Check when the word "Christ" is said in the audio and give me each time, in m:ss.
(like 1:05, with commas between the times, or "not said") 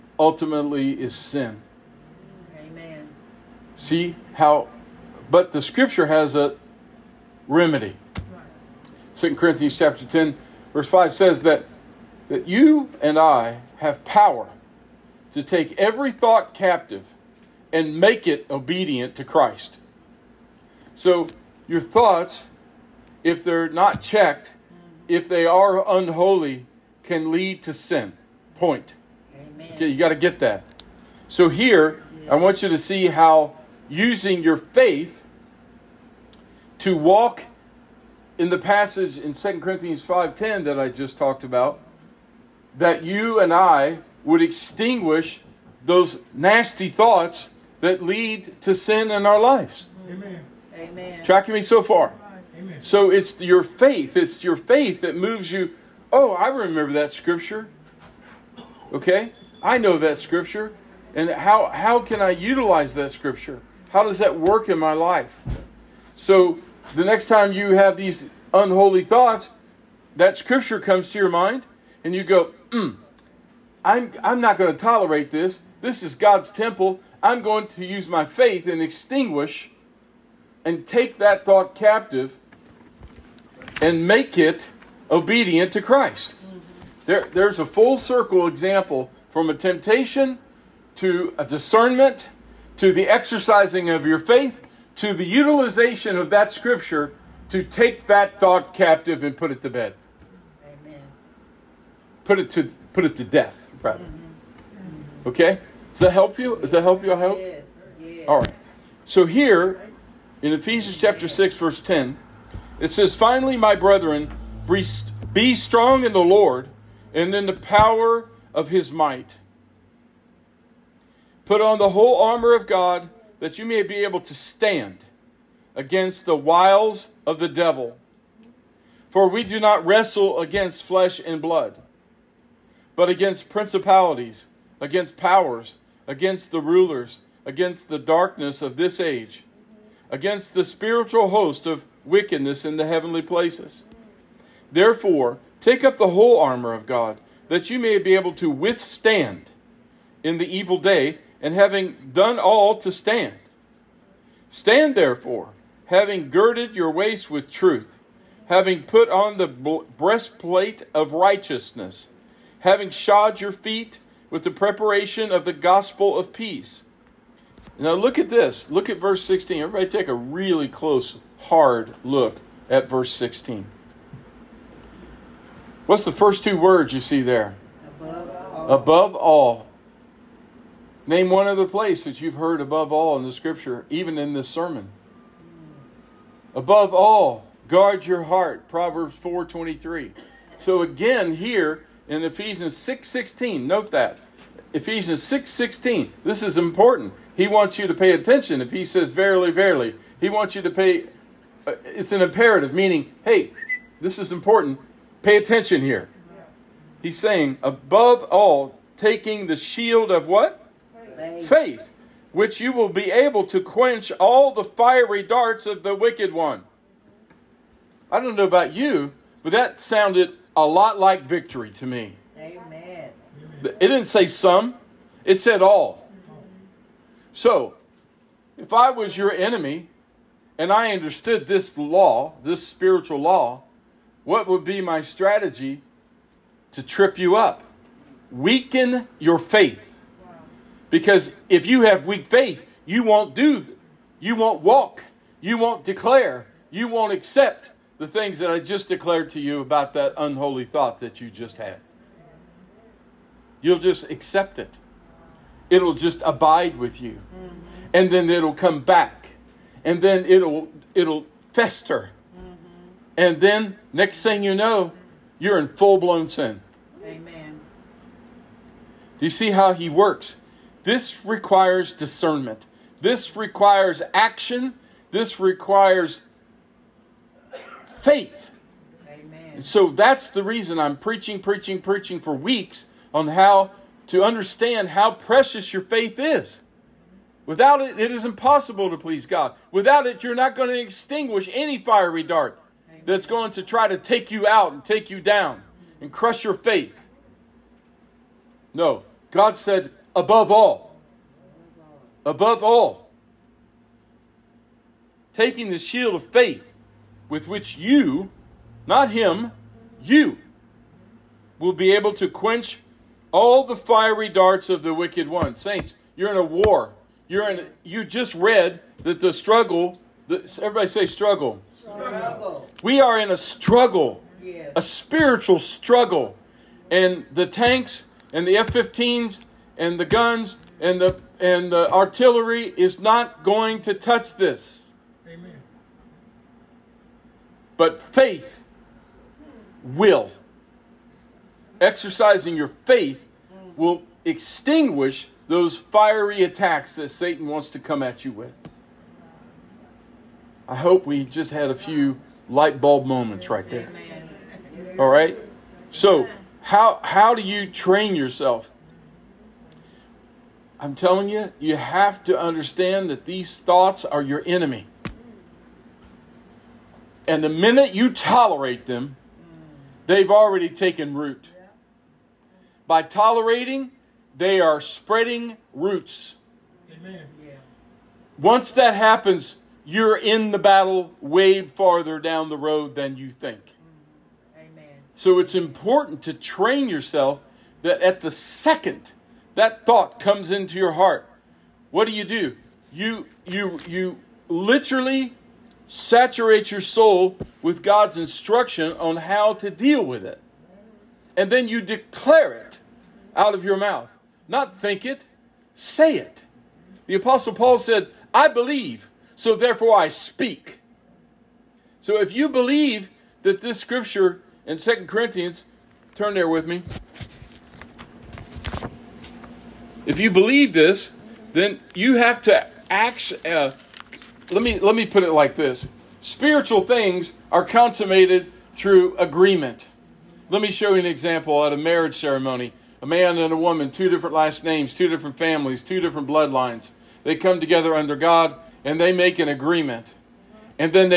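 0:19, 1:25.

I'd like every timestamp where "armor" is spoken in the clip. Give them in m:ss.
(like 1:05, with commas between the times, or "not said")
2:02, 2:26.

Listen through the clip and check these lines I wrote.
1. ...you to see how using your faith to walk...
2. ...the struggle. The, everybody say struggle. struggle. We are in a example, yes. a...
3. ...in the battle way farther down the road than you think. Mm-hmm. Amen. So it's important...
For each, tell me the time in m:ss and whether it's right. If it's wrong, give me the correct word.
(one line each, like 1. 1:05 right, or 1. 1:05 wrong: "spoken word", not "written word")
1. 0:32 right
2. 5:19 wrong: "struggle", not "example"
3. 6:20 right.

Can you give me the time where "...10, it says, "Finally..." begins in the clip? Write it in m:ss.
1:51.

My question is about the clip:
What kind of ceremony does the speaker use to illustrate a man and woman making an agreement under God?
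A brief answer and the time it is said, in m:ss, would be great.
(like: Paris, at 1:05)
Marriage ceremony, at 7:11.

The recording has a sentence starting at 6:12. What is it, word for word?
By tolerating, they are spreading roots.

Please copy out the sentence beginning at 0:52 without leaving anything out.
So it's your faith, it's your faith that moves you, "Oh, I remember that scripture." Okay?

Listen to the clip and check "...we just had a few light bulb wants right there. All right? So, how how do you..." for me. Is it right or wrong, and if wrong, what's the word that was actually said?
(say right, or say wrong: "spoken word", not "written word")
wrong: "moments", not "wants".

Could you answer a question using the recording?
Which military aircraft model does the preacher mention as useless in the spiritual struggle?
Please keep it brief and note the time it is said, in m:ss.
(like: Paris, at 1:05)
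F-15, at 5:28.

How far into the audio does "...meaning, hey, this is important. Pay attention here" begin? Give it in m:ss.
3:22.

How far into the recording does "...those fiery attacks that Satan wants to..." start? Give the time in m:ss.
5:45.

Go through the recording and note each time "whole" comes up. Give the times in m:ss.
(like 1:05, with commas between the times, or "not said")
2:01, 2:26.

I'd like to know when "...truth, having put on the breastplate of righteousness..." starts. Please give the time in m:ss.
2:37.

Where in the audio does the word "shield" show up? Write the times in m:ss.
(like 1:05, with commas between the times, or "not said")
3:29, 5:05.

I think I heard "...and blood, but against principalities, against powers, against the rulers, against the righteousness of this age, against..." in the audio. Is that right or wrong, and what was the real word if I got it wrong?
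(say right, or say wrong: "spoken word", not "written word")
wrong: "darkness", not "righteousness".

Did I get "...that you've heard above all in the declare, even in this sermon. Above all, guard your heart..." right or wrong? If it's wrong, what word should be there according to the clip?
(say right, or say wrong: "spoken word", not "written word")
wrong: "scripture", not "declare".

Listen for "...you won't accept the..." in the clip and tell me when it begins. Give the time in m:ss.
4:06.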